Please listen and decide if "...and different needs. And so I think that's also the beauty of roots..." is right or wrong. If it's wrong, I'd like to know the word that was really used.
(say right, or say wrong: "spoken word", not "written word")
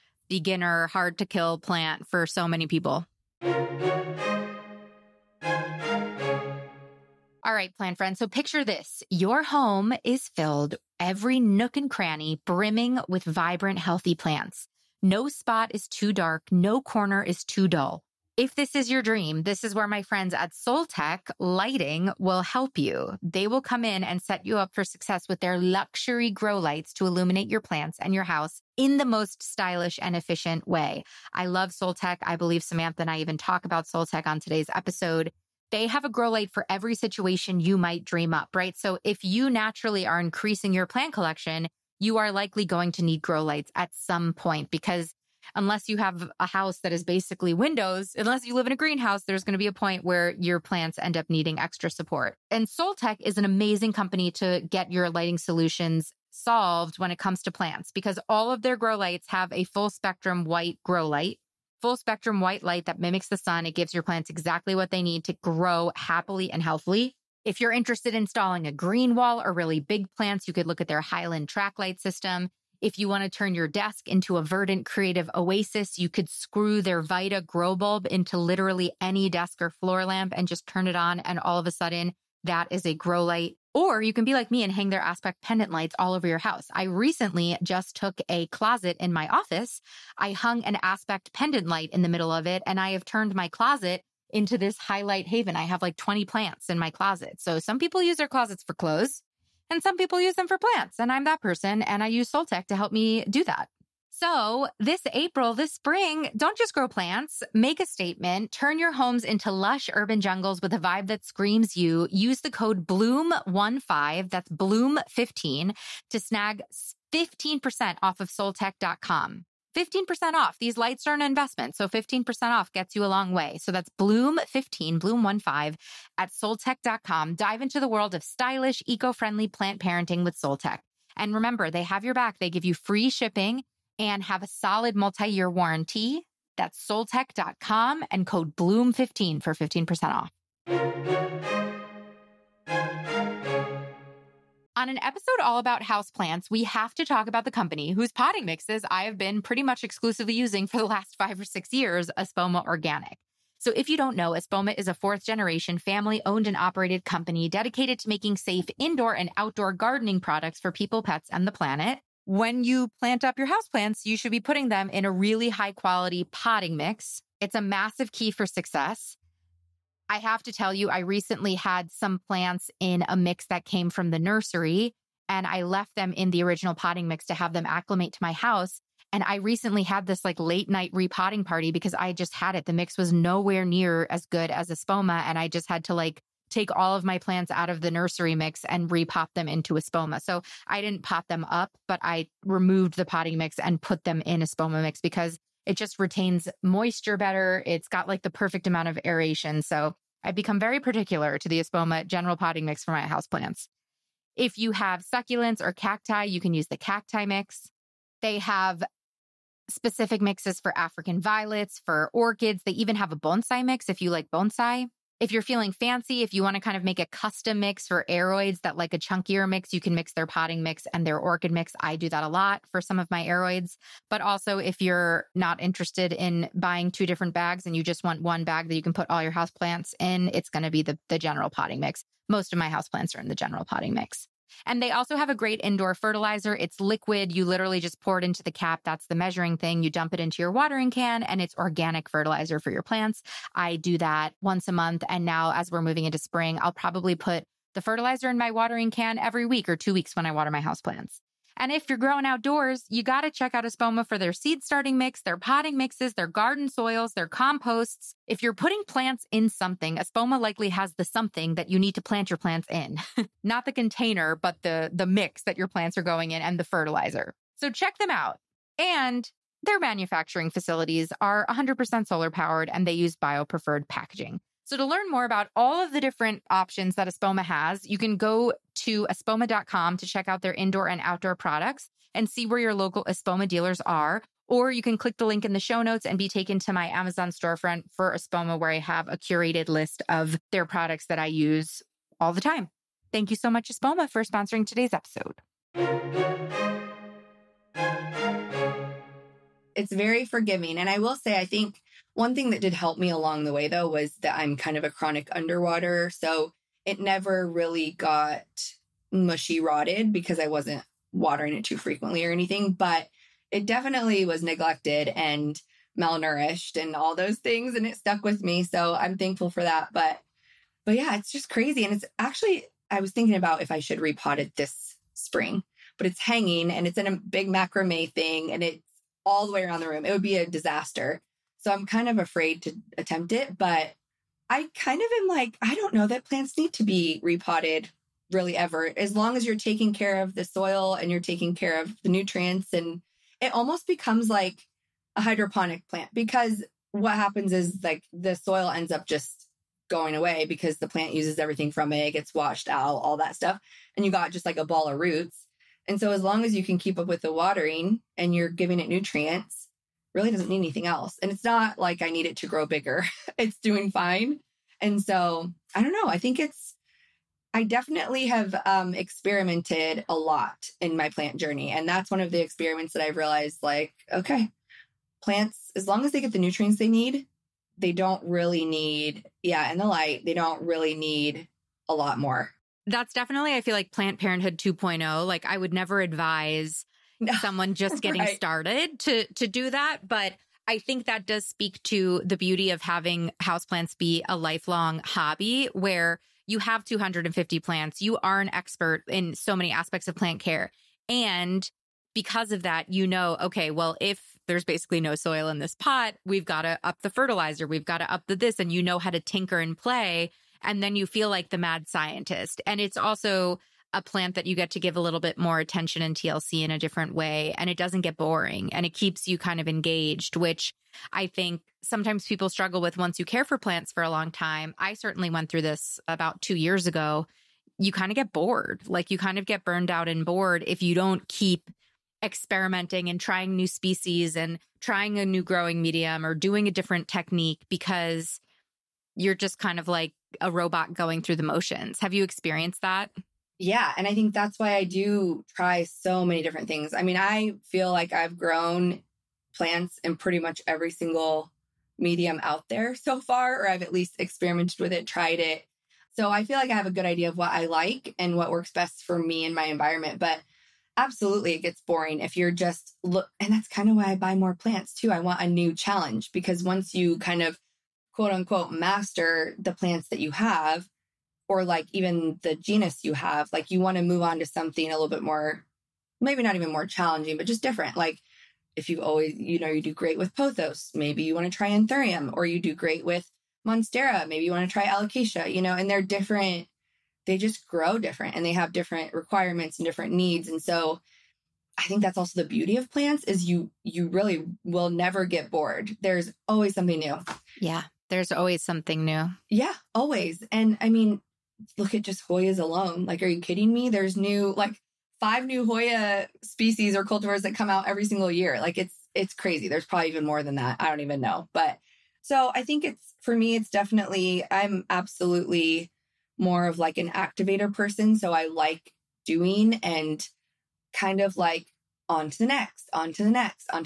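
wrong: "plants", not "roots".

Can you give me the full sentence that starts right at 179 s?
And I recently had this like late night repotting party because I just had it.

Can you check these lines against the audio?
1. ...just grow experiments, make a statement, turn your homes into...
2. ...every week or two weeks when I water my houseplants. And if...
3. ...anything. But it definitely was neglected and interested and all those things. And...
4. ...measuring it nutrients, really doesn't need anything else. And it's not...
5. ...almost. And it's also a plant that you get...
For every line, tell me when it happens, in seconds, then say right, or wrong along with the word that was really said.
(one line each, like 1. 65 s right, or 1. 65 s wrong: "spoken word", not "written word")
1. 106 s wrong: "plants", not "experiments"
2. 249 s right
3. 312 s wrong: "malnourished", not "interested"
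4. 358 s wrong: "giving", not "measuring"
5. 411 s wrong: "scientist", not "almost".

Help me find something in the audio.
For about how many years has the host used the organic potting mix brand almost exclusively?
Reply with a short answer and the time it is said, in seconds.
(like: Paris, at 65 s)
five or six years, at 151 s.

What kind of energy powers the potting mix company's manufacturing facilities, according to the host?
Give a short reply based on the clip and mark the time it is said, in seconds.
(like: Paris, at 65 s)
solar, at 271 s.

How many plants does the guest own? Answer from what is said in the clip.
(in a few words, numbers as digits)
250.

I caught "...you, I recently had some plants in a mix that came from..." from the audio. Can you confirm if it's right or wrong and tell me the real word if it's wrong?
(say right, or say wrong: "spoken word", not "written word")
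right.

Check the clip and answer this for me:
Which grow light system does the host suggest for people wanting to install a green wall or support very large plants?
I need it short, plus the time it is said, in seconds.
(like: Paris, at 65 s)
Highland track light system, at 70 s.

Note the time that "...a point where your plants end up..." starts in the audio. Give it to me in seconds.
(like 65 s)
49 s.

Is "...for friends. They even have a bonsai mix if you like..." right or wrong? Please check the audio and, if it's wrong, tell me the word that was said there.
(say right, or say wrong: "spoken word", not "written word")
wrong: "orchids", not "friends".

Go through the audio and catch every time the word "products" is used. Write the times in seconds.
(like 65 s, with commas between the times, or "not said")
160 s, 281 s, 290 s.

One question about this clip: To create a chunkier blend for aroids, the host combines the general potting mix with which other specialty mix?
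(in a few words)
orchid mix.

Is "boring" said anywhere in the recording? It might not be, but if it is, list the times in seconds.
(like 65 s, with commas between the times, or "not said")
418 s, 461 s.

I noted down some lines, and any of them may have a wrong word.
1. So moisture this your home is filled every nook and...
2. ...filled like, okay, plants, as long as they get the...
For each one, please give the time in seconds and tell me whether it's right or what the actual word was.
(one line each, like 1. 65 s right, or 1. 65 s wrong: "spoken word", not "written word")
1. 8 s wrong: "picture", not "moisture"
2. 373 s wrong: "realized", not "filled".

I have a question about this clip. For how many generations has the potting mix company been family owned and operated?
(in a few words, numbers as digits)
fourth.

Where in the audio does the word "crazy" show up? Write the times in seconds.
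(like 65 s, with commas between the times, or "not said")
321 s, 509 s.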